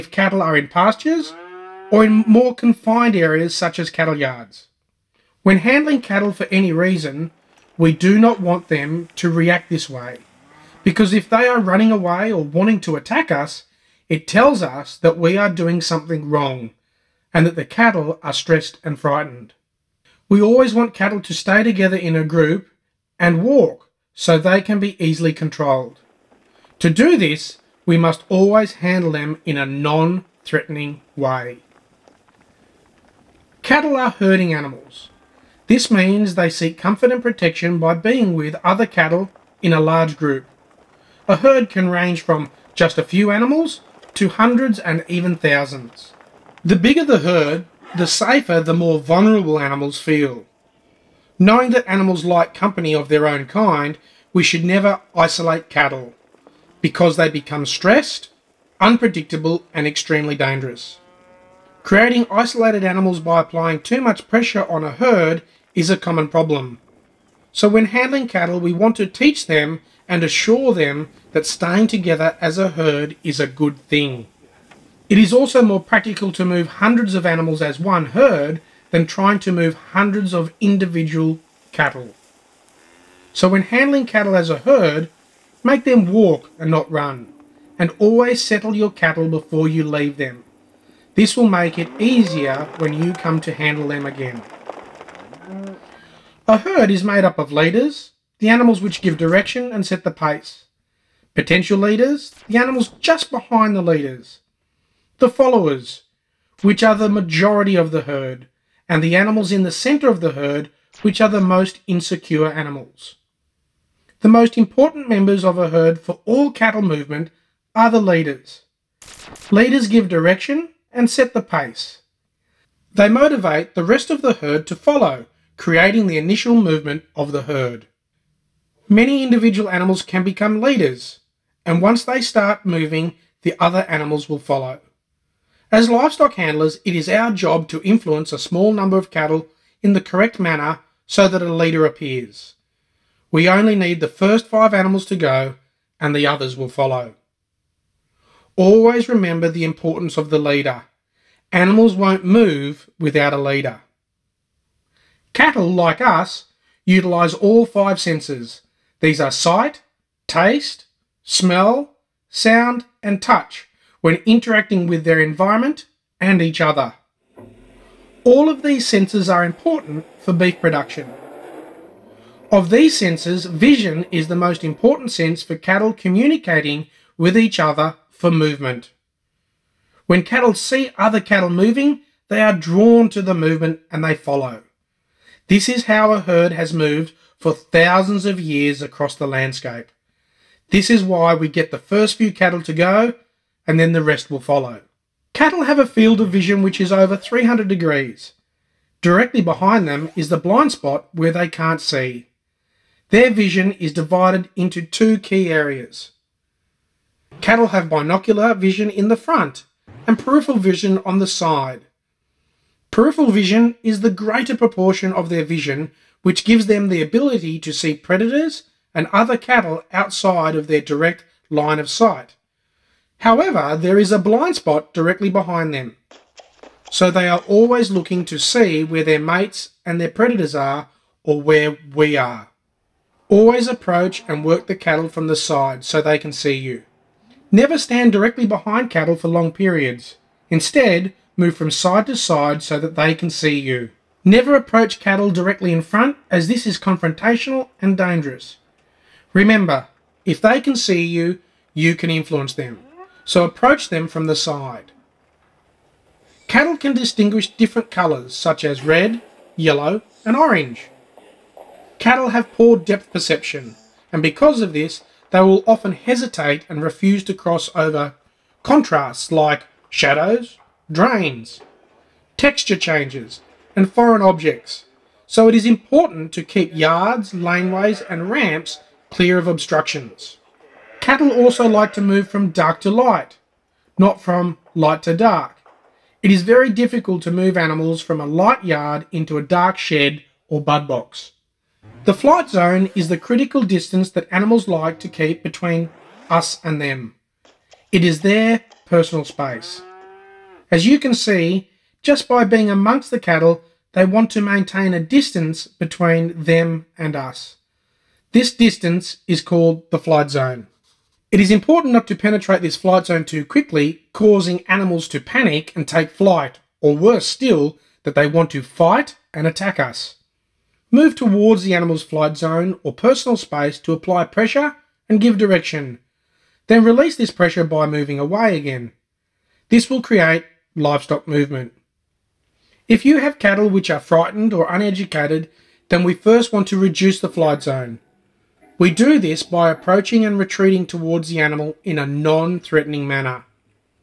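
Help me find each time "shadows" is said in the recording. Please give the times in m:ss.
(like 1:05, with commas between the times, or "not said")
4:29.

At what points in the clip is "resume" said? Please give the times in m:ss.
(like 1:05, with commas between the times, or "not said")
not said.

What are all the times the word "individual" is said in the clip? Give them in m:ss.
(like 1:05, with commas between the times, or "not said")
1:20, 2:09.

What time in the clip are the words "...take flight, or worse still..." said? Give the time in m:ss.
5:15.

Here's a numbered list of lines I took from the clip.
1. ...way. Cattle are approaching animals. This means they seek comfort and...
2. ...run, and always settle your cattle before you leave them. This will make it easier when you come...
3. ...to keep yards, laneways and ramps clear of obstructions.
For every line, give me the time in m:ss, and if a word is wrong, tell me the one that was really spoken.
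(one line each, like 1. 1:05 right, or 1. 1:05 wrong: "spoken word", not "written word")
1. 0:31 wrong: "herding", not "approaching"
2. 1:26 right
3. 4:36 right.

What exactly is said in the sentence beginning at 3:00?
When cattle see other cattle moving, they are drawn to the movement and they follow.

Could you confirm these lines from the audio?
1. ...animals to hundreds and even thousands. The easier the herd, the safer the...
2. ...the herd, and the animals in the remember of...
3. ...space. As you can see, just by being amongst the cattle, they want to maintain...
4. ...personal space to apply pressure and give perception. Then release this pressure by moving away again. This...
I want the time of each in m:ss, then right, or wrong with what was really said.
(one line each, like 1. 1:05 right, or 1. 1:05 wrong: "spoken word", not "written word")
1. 0:43 wrong: "bigger", not "easier"
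2. 1:47 wrong: "center", not "remember"
3. 4:59 right
4. 5:22 wrong: "direction", not "perception".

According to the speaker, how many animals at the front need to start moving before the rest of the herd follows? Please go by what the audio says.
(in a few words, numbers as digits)
5.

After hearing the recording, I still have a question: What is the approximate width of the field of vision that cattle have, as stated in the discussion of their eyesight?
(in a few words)
over 300 degrees.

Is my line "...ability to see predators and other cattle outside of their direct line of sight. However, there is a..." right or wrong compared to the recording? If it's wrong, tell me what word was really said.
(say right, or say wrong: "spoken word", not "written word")
right.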